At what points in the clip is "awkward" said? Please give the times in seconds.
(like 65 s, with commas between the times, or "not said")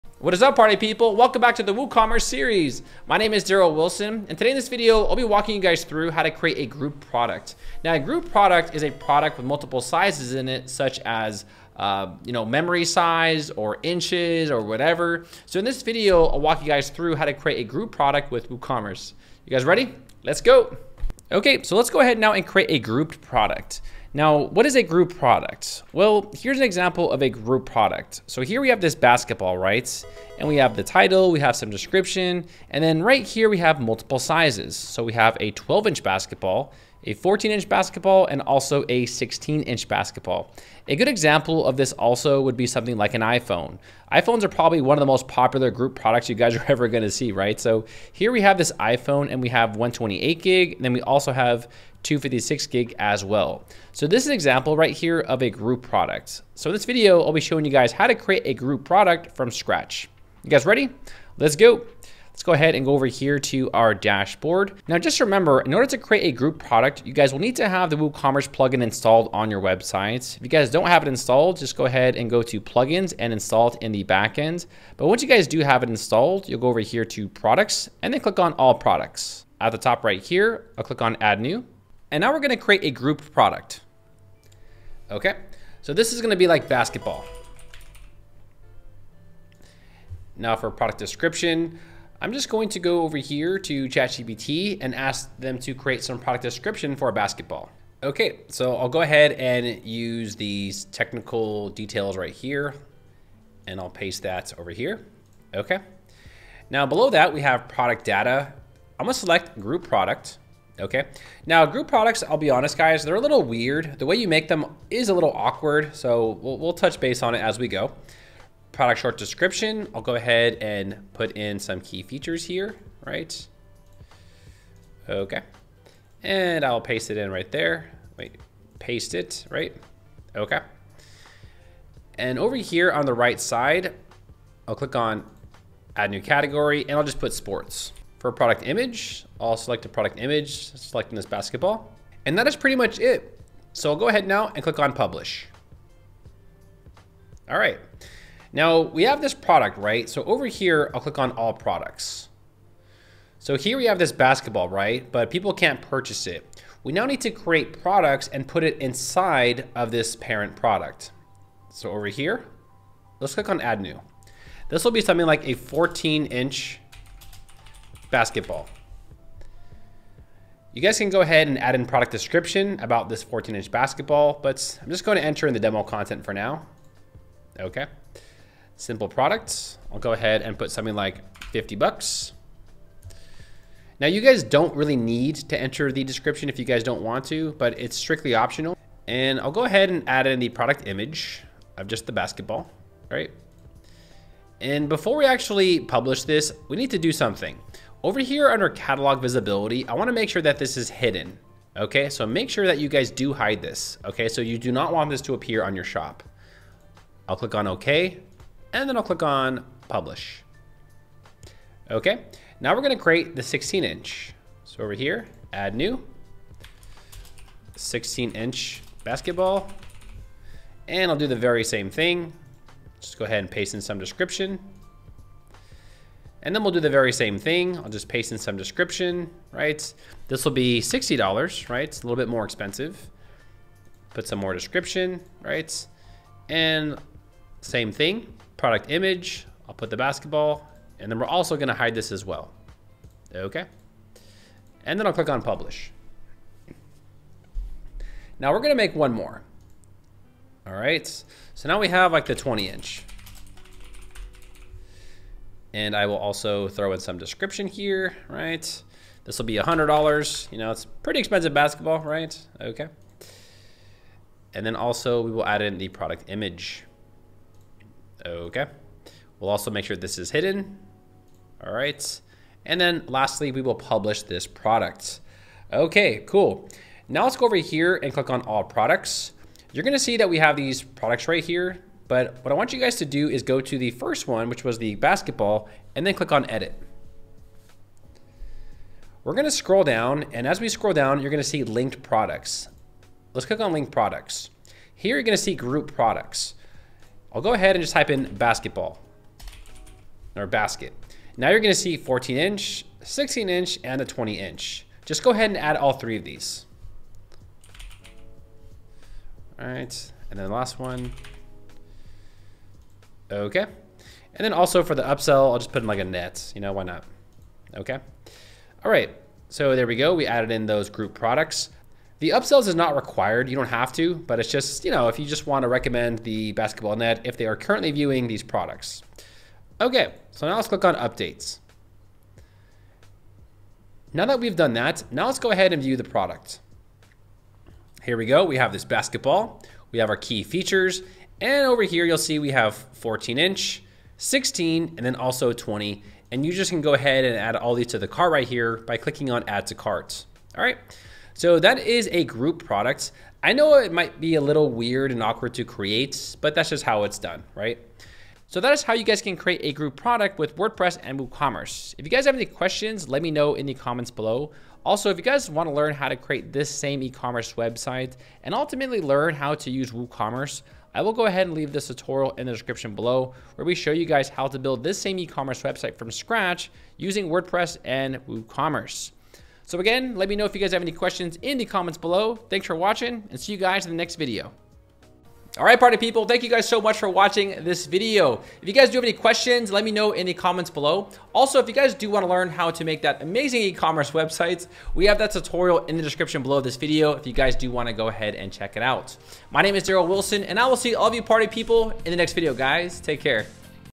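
115 s, 355 s.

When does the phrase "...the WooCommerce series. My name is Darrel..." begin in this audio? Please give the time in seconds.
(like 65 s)
1 s.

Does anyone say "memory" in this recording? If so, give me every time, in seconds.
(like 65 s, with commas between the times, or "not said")
12 s.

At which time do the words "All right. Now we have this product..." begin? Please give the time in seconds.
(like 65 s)
147 s.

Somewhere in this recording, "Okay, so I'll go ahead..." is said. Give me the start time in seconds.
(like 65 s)
98 s.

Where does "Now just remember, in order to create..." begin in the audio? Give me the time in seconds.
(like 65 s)
64 s.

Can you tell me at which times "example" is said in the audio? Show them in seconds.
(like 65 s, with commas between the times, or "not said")
26 s, 41 s, 54 s.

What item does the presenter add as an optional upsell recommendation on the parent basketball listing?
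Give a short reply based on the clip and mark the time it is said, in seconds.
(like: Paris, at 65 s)
A net, at 315 s.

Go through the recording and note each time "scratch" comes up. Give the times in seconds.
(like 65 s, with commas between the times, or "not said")
59 s, 376 s.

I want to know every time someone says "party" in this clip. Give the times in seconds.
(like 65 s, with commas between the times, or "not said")
0 s, 385 s, 401 s.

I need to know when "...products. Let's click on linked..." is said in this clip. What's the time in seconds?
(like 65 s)
292 s.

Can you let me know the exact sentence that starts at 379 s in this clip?
So again, let me know if you guys have any questions in the comments below.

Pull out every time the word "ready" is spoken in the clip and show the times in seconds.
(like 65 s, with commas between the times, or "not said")
19 s, 60 s.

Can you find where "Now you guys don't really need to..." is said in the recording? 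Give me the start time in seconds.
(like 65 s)
183 s.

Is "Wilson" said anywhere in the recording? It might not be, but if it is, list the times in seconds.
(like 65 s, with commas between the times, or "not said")
3 s, 400 s.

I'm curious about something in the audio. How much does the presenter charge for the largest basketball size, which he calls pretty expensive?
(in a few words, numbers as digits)
$100.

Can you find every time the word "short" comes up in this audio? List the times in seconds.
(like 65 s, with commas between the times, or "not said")
118 s.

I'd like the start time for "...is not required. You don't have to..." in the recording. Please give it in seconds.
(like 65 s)
322 s.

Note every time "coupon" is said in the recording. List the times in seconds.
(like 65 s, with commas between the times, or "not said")
not said.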